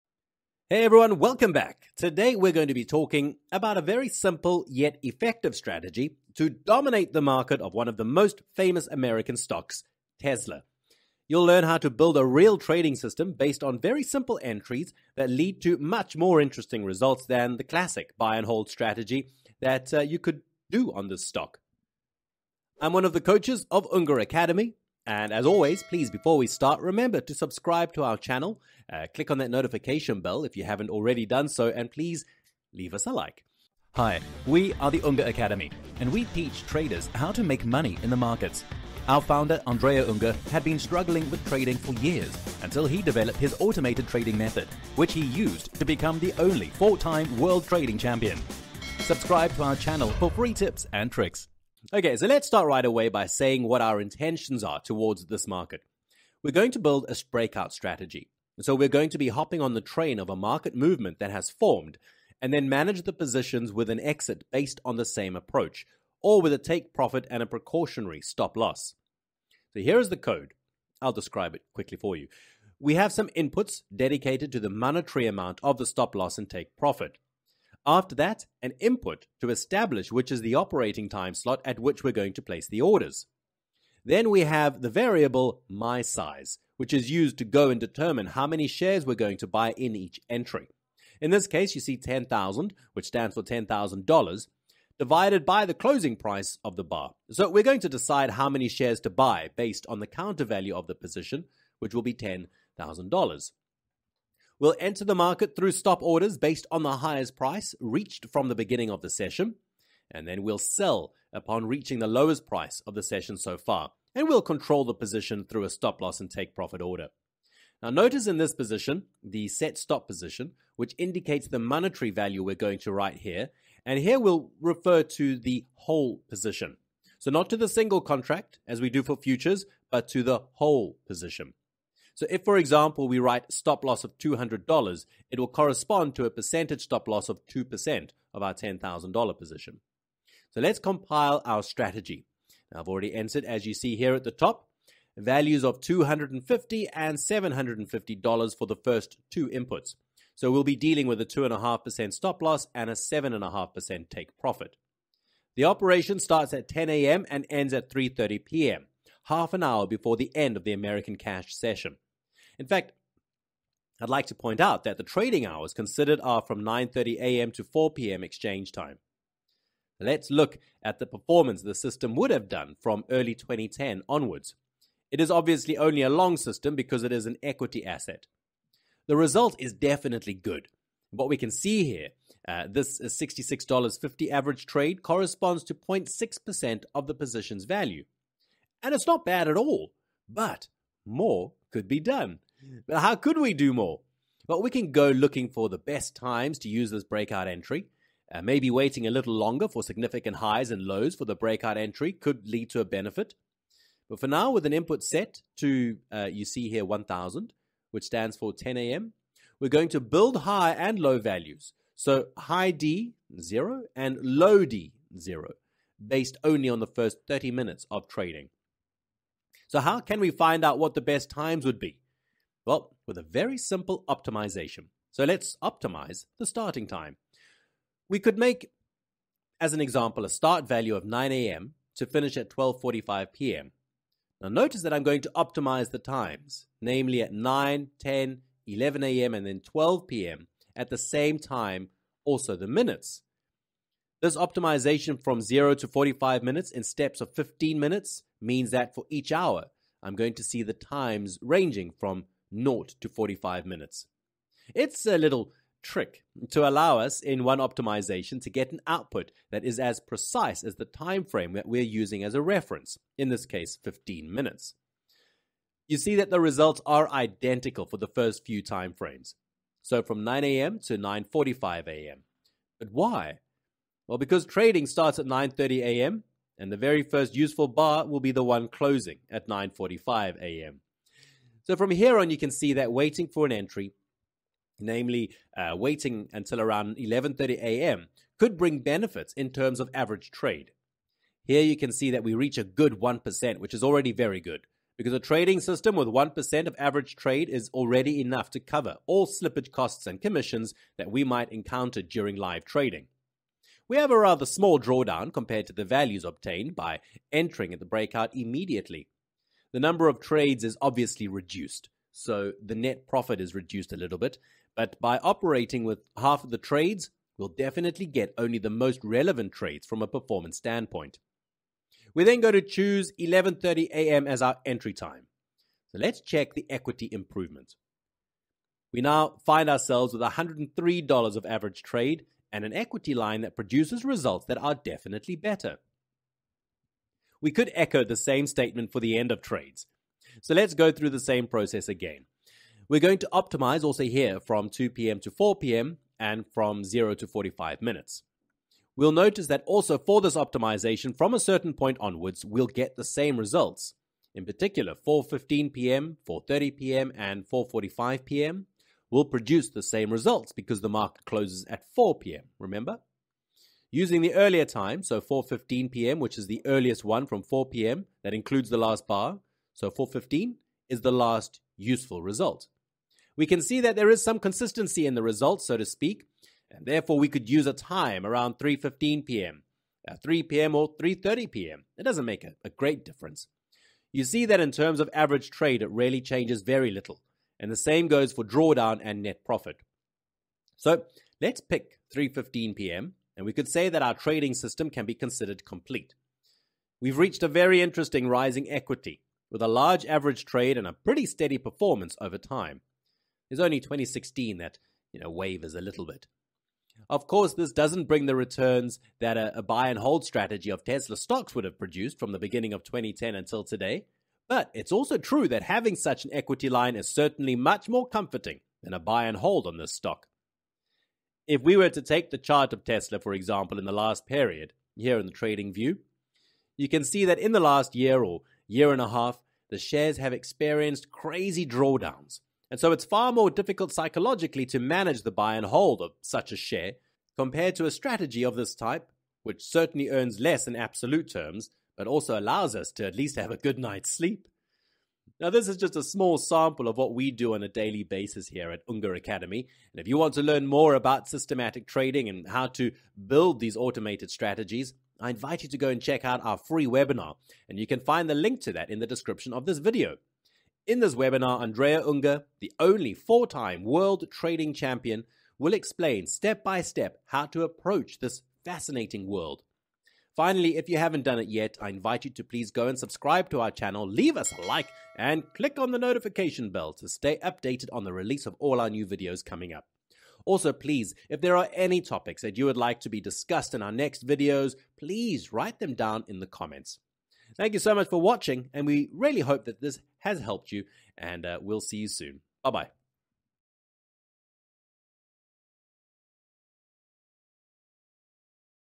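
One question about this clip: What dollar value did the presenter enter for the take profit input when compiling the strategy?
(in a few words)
$750.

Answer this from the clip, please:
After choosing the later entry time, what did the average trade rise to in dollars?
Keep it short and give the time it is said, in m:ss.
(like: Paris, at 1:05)
$103, at 5:30.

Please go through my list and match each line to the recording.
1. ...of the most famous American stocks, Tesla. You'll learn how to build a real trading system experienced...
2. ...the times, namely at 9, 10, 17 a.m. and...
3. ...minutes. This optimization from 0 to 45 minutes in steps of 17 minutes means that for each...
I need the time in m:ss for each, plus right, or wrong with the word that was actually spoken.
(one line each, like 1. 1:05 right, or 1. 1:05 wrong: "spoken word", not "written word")
1. 0:07 wrong: "based", not "experienced"
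2. 3:55 wrong: "11", not "17"
3. 4:02 wrong: "15", not "17".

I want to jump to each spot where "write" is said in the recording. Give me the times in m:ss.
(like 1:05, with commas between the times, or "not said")
2:02, 2:13, 8:05.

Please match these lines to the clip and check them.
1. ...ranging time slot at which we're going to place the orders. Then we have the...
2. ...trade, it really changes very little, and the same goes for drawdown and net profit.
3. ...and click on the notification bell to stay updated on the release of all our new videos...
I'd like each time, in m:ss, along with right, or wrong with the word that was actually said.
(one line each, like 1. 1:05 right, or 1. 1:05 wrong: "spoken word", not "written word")
1. 1:20 wrong: "operating", not "ranging"
2. 6:25 right
3. 7:55 right.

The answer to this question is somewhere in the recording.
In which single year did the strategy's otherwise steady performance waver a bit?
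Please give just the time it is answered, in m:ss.
6:43.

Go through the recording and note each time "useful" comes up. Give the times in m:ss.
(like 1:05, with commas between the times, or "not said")
4:37, 6:11.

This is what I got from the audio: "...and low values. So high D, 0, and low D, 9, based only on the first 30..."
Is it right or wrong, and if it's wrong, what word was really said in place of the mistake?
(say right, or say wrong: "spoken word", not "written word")
wrong: "0", not "9".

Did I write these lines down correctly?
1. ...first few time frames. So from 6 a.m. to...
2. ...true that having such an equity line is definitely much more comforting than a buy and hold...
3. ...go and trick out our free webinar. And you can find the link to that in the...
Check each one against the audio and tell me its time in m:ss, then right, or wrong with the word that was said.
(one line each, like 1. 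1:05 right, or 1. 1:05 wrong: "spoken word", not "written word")
1. 4:28 wrong: "9", not "6"
2. 6:55 wrong: "certainly", not "definitely"
3. 7:35 wrong: "check", not "trick".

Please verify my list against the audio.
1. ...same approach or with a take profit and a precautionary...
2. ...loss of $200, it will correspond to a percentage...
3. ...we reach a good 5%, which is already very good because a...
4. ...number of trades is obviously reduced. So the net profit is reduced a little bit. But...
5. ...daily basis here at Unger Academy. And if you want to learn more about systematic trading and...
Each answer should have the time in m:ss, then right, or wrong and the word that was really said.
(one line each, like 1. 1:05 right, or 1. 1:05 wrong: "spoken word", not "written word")
1. 1:05 right
2. 2:13 right
3. 4:52 wrong: "1", not "5"
4. 5:09 right
5. 7:27 right.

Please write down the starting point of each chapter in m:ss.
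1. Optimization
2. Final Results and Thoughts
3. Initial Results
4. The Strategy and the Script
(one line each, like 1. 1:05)
1. 3:39
2. 7:01
3. 2:49
4. 0:52.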